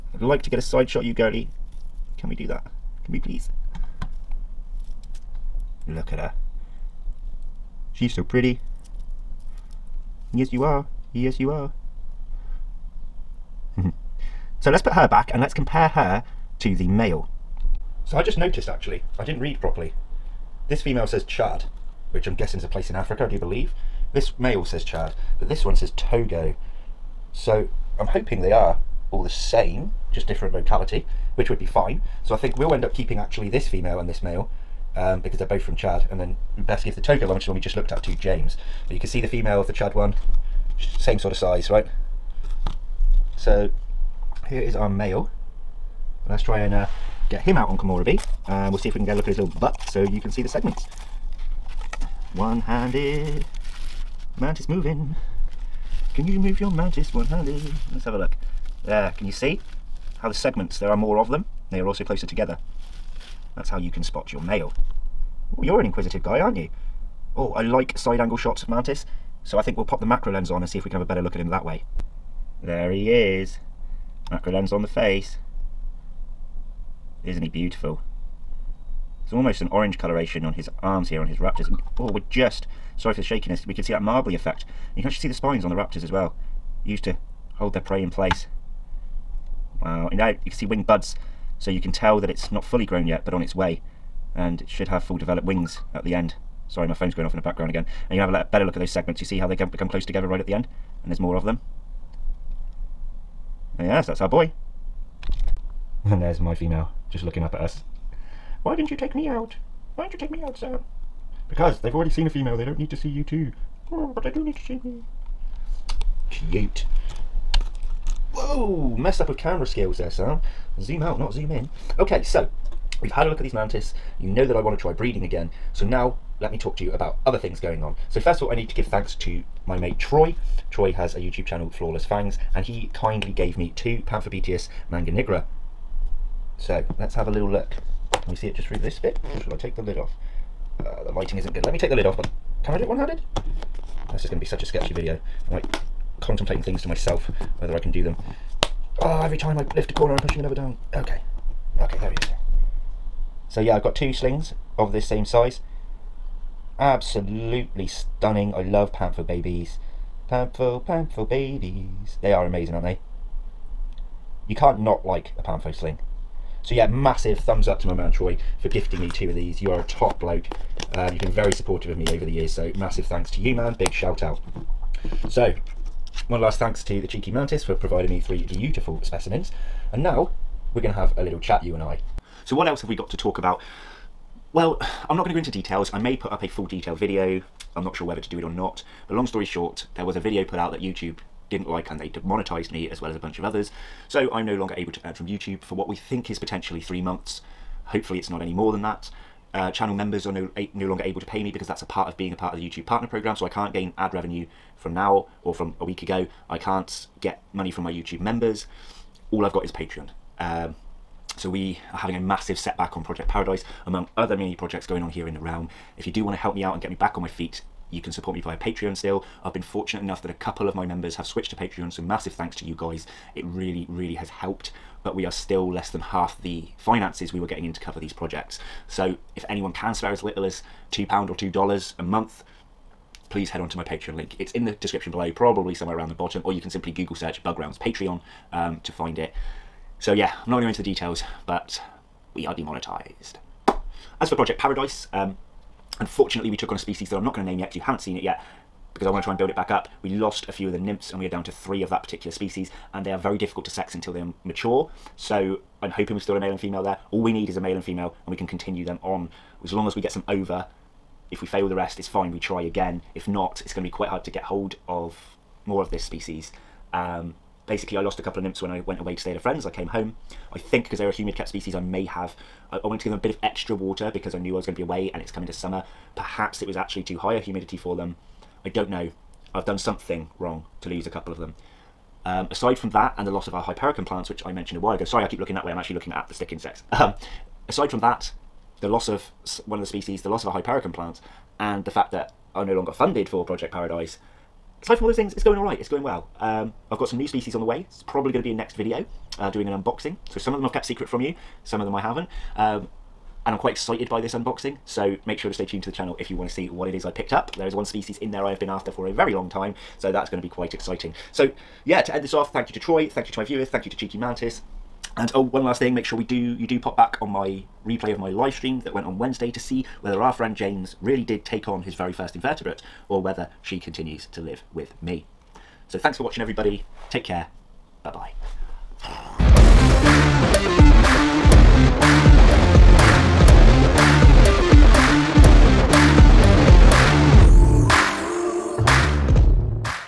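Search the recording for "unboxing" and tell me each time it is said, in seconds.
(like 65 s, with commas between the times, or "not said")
299 s, 304 s.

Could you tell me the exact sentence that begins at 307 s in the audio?
There is one species in there I have been after for a very long time, so that's going to be quite exciting.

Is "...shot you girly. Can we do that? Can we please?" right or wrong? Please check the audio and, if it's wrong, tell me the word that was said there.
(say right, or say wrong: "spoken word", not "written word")
right.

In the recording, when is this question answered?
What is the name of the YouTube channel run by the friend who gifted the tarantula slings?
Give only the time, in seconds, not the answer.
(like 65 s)
131 s.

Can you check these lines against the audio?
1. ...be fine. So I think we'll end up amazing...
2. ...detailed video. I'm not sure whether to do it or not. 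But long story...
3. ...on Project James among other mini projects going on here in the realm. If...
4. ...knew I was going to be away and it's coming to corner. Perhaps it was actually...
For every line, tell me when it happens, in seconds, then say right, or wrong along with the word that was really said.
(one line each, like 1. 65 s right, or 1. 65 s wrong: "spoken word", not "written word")
1. 31 s wrong: "keeping", not "amazing"
2. 186 s right
3. 212 s wrong: "Paradise", not "James"
4. 274 s wrong: "summer", not "corner".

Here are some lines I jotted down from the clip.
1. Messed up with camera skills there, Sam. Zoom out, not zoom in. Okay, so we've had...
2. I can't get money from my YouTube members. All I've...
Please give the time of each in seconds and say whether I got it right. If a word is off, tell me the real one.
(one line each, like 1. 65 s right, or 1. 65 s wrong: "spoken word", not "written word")
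1. 118 s right
2. 206 s right.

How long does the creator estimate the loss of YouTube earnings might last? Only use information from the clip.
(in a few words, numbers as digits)
3 months.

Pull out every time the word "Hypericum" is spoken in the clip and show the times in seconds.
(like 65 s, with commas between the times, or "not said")
283 s, 290 s.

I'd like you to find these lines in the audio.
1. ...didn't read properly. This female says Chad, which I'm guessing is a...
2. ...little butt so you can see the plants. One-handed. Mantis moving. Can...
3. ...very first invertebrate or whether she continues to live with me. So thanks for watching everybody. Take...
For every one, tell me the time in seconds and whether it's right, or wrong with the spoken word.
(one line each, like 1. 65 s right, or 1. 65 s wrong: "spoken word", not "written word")
1. 19 s right
2. 49 s wrong: "segments", not "plants"
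3. 321 s right.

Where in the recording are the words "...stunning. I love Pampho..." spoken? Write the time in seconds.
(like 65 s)
157 s.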